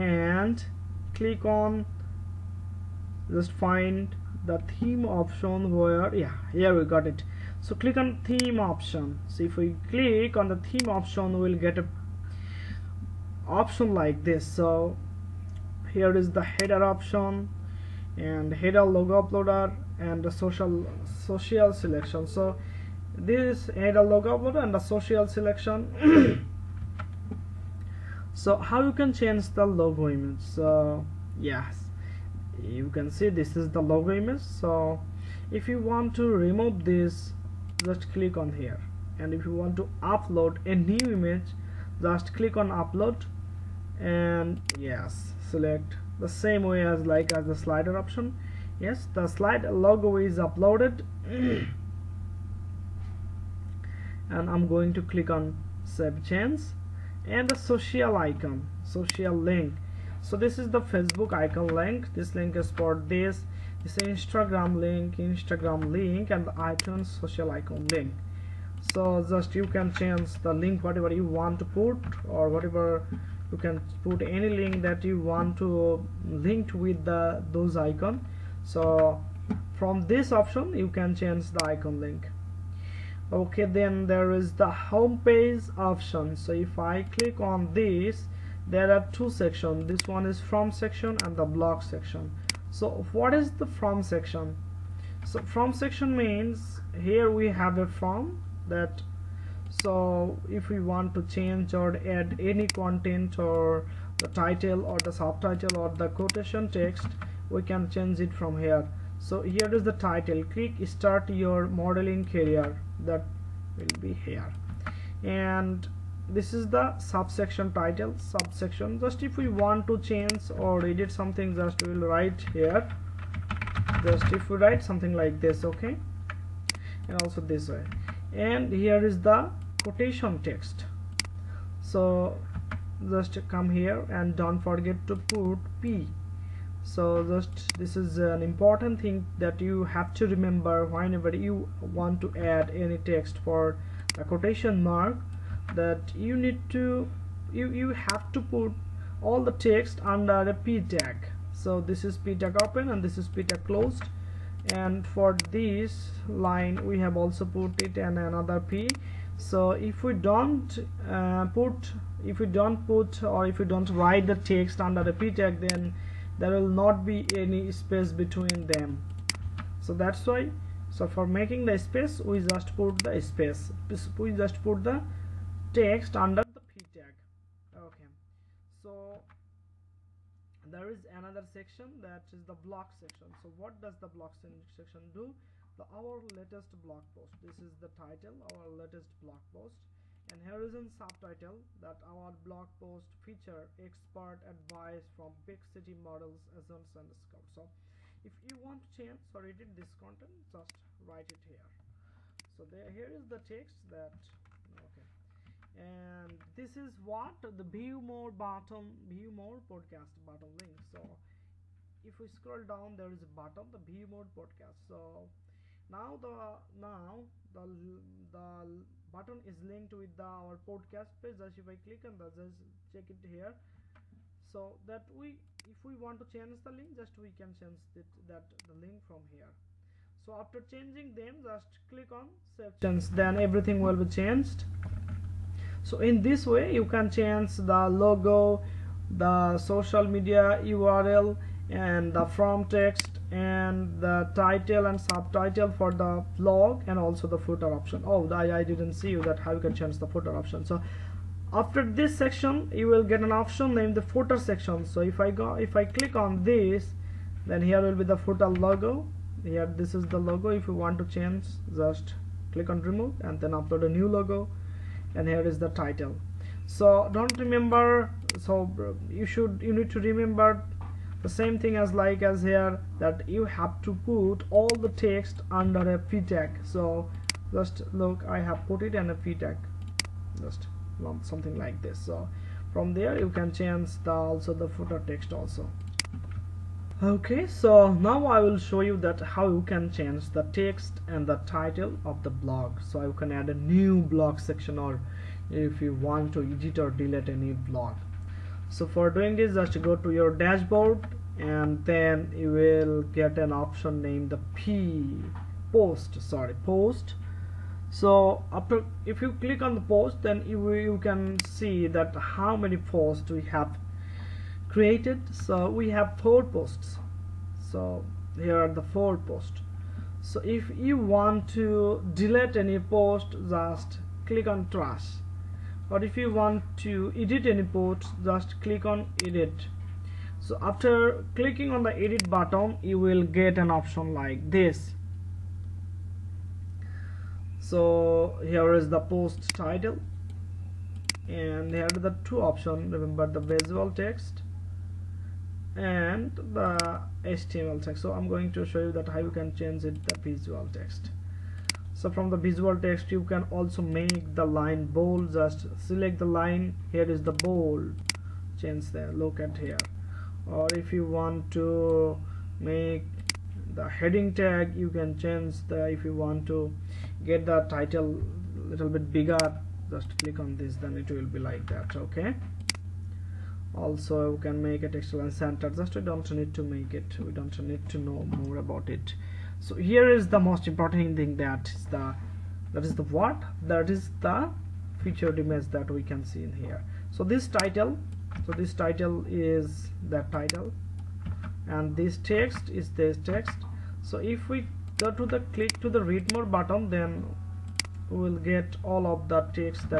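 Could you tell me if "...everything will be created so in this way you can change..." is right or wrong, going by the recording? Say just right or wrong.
wrong.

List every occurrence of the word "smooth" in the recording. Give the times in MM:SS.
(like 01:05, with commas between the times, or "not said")
not said.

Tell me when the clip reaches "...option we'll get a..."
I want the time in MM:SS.
00:10.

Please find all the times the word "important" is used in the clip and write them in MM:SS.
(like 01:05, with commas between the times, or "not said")
02:18, 06:20.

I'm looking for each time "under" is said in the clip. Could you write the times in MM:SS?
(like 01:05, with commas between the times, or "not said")
02:30, 02:44, 02:56, 04:35.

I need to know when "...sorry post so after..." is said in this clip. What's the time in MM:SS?
05:06.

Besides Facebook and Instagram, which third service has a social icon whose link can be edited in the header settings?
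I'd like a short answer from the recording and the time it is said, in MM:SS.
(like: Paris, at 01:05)
iTunes, at 01:06.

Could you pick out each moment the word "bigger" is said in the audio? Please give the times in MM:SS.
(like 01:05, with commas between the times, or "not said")
06:09.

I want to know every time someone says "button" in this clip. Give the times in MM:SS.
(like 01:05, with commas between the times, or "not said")
03:39, 05:32, 06:36.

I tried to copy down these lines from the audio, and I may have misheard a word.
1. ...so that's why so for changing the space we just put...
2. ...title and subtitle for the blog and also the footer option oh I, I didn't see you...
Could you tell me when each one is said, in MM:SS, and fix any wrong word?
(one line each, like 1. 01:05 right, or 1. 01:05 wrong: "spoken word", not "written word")
1. 02:49 wrong: "making", not "changing"
2. 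04:04 right.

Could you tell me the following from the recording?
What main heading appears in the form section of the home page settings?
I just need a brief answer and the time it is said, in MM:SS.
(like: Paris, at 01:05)
Start your modeling career, at 01:50.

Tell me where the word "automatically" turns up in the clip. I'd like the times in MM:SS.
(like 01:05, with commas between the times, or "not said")
not said.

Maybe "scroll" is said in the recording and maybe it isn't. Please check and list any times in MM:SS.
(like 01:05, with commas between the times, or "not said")
03:32.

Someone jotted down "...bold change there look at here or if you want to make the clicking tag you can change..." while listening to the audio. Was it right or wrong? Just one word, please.
wrong.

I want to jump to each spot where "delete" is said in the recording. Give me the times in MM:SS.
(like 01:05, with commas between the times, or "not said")
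04:56, 05:22.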